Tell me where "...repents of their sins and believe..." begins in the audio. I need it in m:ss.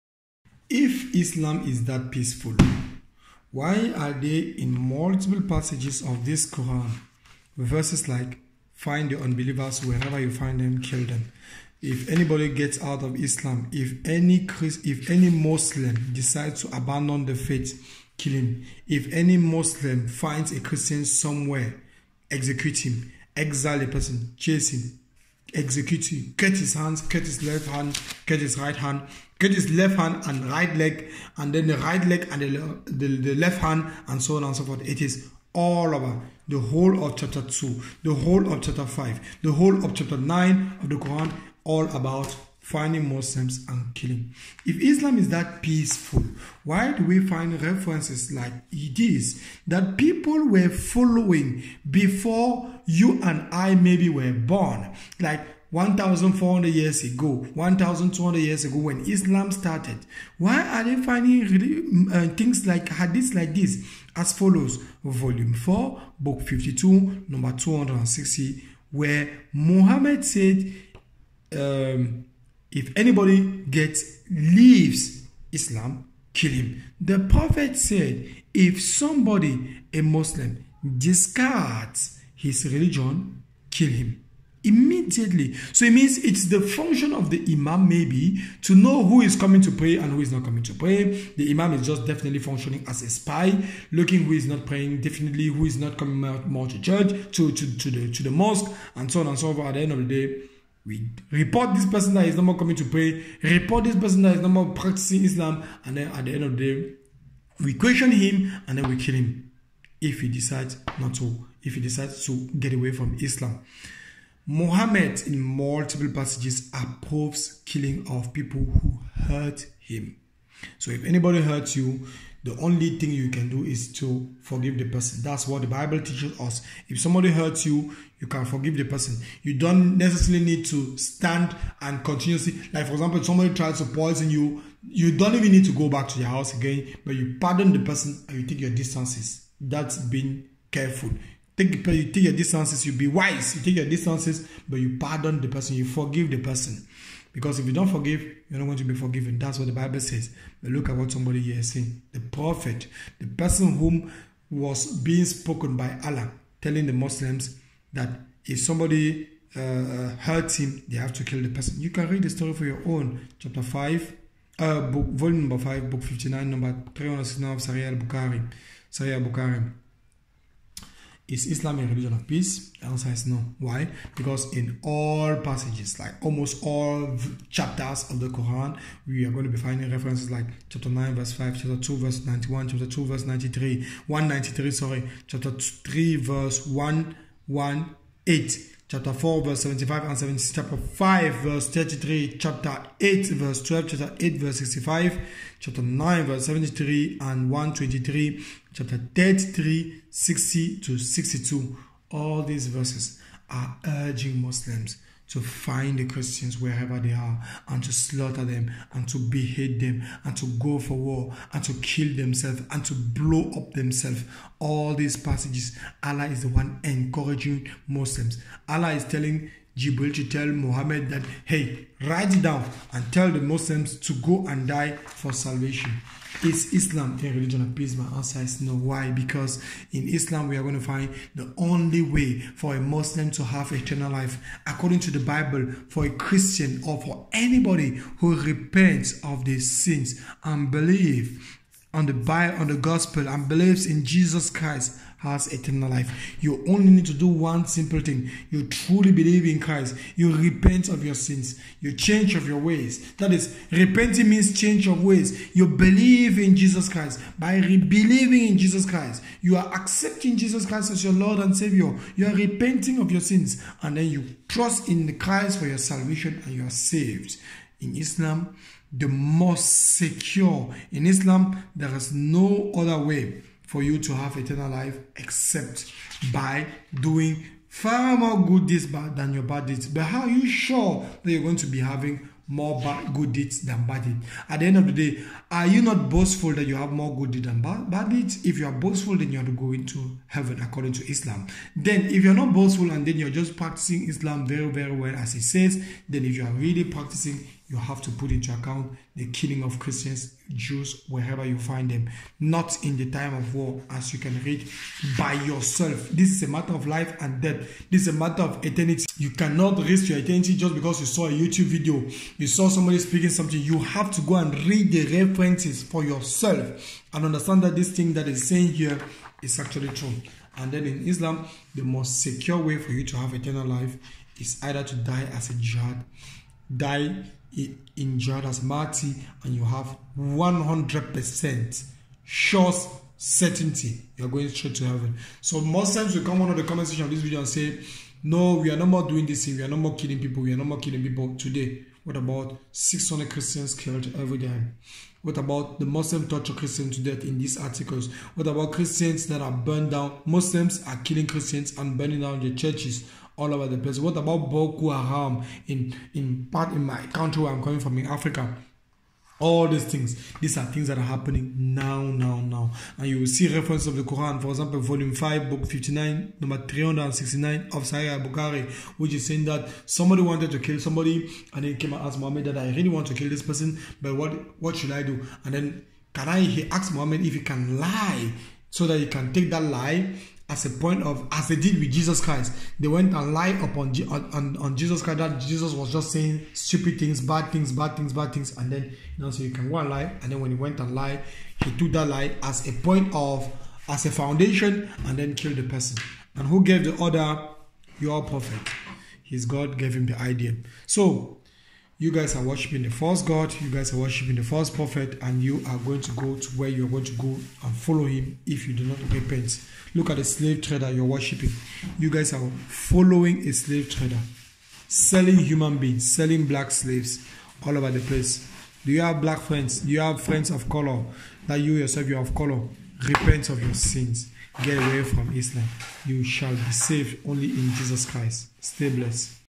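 3:58.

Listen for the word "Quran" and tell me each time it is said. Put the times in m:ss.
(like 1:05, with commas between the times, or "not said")
0:06, 0:40, 2:58, 6:04.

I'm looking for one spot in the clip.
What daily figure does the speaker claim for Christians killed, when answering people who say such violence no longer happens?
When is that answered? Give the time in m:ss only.
5:42.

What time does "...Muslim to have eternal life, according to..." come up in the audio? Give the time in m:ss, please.
3:52.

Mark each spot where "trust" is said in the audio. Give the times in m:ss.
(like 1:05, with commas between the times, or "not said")
4:24.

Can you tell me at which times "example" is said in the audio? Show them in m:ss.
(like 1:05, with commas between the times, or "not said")
2:12, 6:04.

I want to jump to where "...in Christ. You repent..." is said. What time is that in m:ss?
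4:09.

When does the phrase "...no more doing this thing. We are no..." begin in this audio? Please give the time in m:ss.
5:38.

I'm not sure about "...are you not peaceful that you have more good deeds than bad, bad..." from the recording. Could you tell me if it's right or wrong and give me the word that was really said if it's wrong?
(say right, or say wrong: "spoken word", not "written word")
wrong: "boastful", not "peaceful".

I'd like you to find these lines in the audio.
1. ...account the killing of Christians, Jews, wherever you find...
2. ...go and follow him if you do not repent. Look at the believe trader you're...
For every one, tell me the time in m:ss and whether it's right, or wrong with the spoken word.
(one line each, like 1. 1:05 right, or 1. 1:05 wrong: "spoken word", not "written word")
1. 4:58 right
2. 6:47 wrong: "slave", not "believe".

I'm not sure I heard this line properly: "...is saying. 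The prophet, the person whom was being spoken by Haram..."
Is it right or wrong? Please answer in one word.
wrong.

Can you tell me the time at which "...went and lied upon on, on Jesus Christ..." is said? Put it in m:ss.
6:22.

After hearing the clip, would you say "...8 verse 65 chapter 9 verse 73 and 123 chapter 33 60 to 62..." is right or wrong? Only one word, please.
right.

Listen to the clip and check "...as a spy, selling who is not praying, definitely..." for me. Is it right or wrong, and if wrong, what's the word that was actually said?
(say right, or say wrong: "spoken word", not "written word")
wrong: "looking", not "selling".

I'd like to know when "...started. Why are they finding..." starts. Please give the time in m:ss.
0:59.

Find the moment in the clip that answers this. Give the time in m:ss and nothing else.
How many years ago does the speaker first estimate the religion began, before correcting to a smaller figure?
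0:55.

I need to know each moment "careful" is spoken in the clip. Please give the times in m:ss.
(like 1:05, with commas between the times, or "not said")
2:20.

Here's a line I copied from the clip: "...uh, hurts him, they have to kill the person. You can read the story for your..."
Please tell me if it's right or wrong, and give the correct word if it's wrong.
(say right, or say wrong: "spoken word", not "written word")
right.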